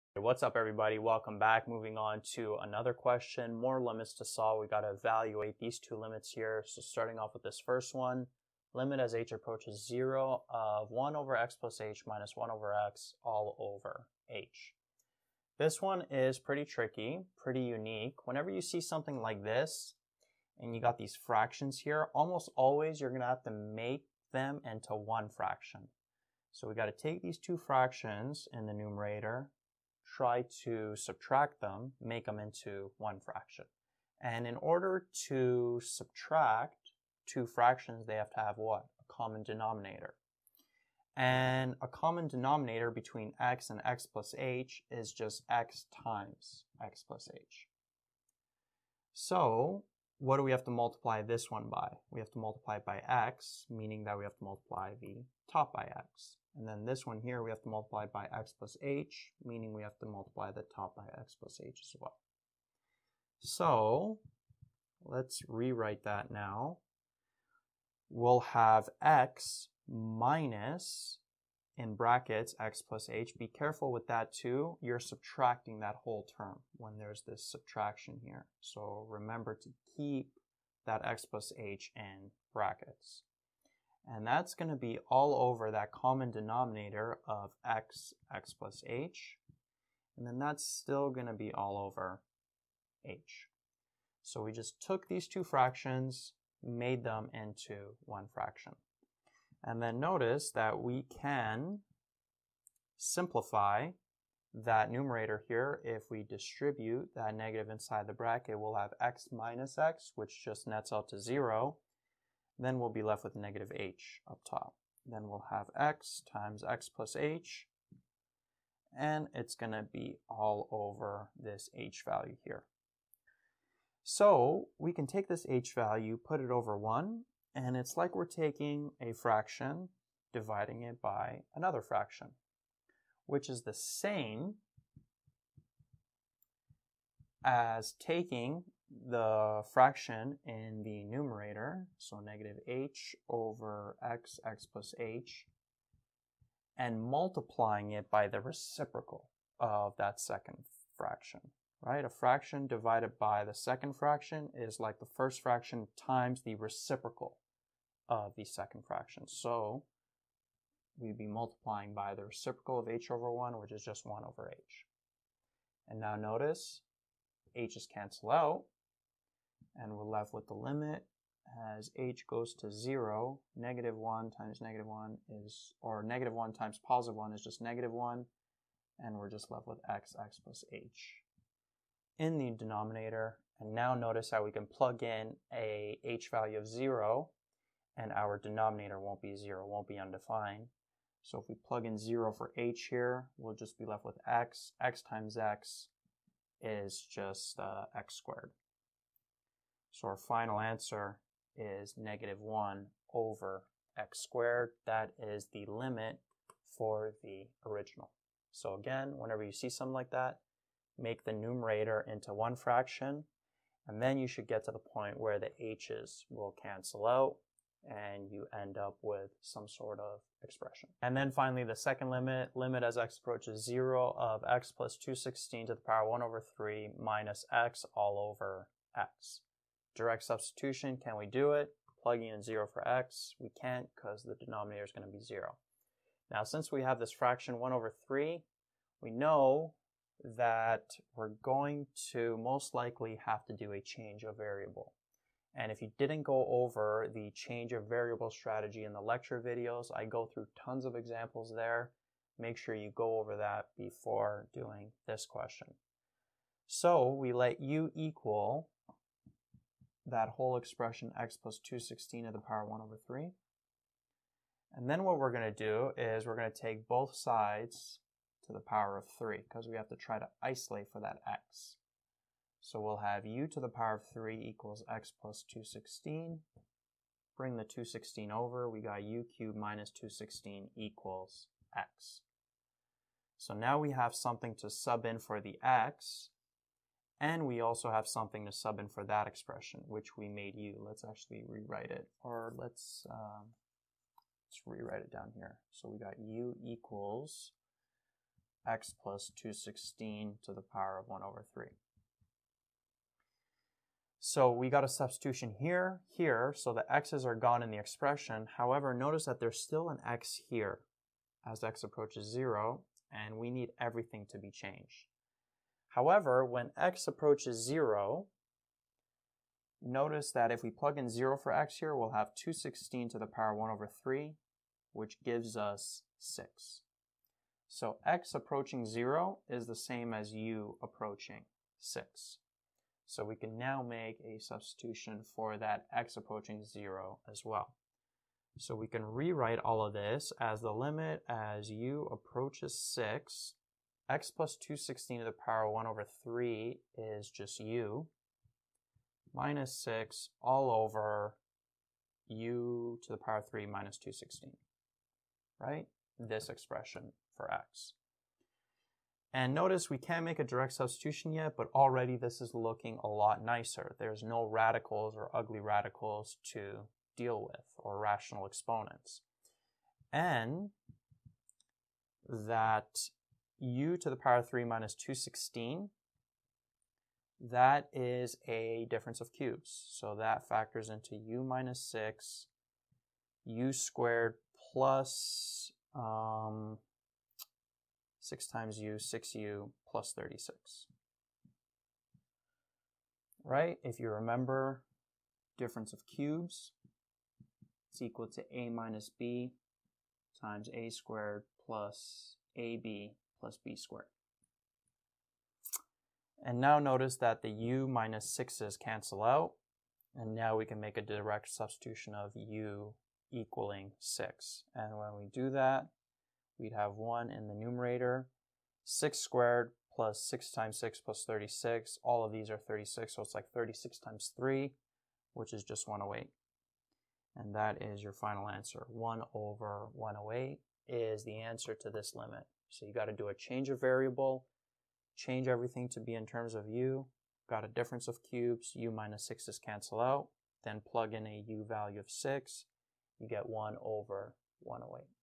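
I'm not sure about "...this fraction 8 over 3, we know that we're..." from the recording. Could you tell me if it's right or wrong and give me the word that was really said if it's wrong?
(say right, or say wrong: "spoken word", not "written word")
wrong: "1", not "8".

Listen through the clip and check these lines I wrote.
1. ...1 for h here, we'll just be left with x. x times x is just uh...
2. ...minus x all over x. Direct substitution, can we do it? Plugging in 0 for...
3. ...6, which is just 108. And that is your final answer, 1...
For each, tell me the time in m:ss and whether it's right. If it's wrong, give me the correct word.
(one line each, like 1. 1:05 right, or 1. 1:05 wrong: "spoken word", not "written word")
1. 3:11 wrong: "0", not "1"
2. 3:46 right
3. 7:04 wrong: "3", not "6".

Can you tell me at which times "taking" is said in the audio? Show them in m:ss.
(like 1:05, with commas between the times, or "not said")
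2:08, 2:17.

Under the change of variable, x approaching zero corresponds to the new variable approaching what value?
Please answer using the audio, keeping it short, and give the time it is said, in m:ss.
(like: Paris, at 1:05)
6, at 5:30.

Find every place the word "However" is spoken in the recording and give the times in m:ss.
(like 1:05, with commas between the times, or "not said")
5:08, 5:15.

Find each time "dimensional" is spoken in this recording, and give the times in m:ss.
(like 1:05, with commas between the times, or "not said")
not said.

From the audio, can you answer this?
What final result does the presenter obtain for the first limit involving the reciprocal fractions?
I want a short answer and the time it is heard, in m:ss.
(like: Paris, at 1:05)
-1/x^2, at 3:21.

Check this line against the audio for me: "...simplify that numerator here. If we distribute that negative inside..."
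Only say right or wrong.
right.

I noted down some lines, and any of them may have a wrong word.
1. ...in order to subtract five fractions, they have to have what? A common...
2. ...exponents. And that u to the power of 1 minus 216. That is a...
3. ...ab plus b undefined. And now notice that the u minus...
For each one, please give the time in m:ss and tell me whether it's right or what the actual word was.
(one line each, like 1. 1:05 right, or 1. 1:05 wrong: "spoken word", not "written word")
1. 0:34 wrong: "two", not "five"
2. 6:08 wrong: "3", not "1"
3. 6:42 wrong: "squared", not "undefined".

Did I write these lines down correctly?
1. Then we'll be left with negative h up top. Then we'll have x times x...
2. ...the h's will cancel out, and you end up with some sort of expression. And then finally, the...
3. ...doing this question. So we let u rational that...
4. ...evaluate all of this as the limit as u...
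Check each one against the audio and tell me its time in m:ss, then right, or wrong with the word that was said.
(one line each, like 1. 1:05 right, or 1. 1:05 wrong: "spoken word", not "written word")
1. 1:52 right
2. 3:35 right
3. 4:14 wrong: "equal", not "rational"
4. 5:39 wrong: "rewrite", not "evaluate".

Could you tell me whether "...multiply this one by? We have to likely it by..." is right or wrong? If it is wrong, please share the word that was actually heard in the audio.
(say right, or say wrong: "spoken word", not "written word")
wrong: "multiply", not "likely".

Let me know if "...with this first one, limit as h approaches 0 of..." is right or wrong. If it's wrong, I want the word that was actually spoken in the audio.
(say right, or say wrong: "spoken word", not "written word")
right.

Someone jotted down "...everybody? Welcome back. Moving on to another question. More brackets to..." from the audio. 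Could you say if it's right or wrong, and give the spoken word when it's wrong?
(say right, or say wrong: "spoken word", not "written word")
wrong: "limits", not "brackets".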